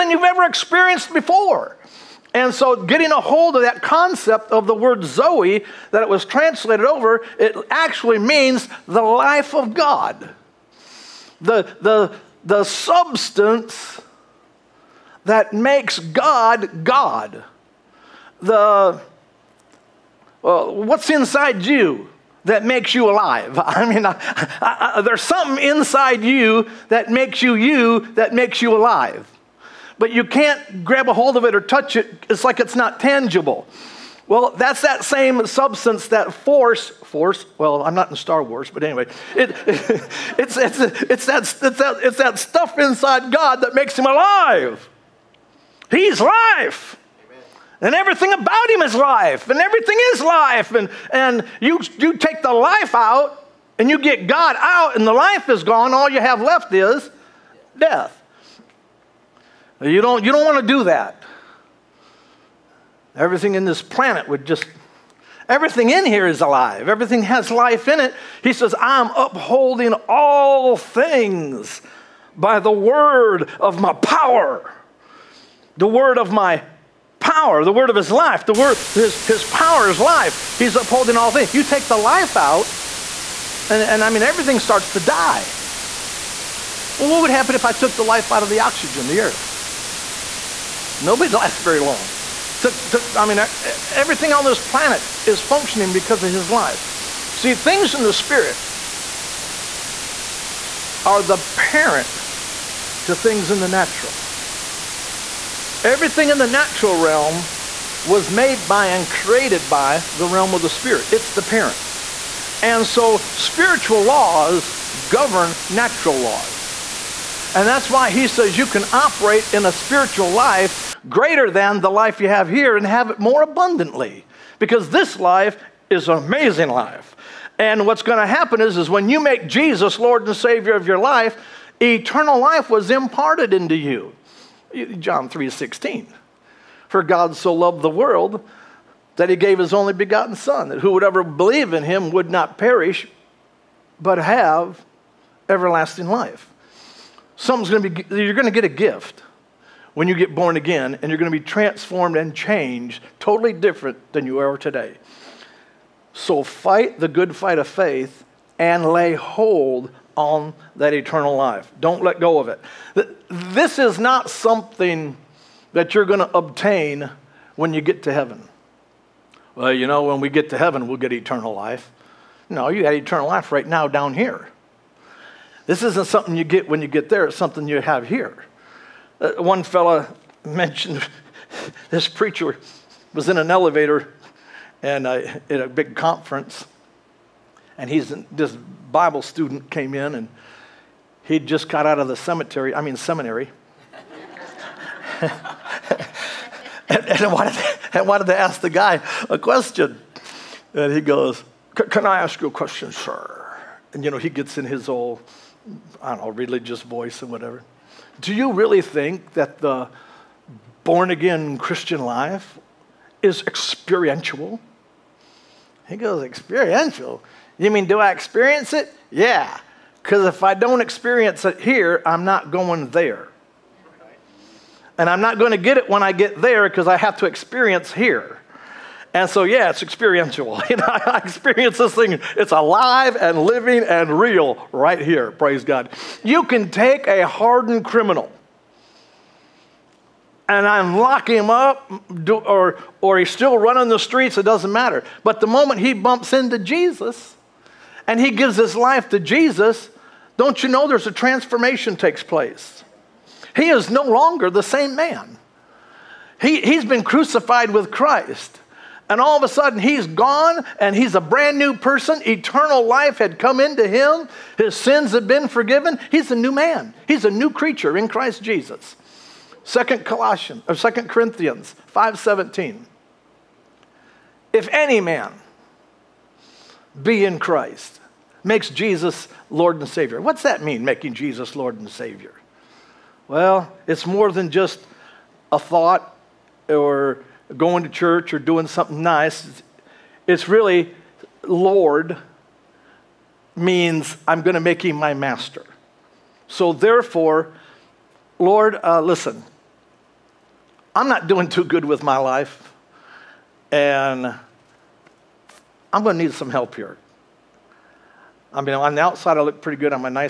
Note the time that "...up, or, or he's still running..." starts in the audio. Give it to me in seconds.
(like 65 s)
241 s.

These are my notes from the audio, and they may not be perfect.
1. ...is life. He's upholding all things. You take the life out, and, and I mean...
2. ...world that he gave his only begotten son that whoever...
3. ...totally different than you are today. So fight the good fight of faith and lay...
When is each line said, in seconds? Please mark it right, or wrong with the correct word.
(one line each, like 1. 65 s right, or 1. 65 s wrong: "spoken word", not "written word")
1. 79 s right
2. 137 s right
3. 153 s right.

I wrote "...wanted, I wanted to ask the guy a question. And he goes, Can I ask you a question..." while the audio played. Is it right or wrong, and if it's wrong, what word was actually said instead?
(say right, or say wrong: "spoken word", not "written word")
right.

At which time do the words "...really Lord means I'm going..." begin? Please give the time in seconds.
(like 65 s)
290 s.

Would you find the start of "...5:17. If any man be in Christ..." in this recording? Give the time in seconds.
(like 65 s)
271 s.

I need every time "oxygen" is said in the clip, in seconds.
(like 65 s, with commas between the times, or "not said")
88 s.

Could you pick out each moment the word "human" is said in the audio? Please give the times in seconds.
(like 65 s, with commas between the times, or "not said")
not said.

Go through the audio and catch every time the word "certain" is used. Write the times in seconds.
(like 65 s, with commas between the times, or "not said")
not said.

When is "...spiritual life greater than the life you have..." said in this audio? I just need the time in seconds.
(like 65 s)
119 s.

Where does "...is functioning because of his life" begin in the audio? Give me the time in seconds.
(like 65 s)
95 s.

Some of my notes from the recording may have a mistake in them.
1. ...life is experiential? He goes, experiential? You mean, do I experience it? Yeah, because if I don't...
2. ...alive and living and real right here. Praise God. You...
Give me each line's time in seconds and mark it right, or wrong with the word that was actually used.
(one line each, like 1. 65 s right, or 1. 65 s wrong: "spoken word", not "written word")
1. 212 s right
2. 232 s right.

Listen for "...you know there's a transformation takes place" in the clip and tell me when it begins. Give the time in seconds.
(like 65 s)
250 s.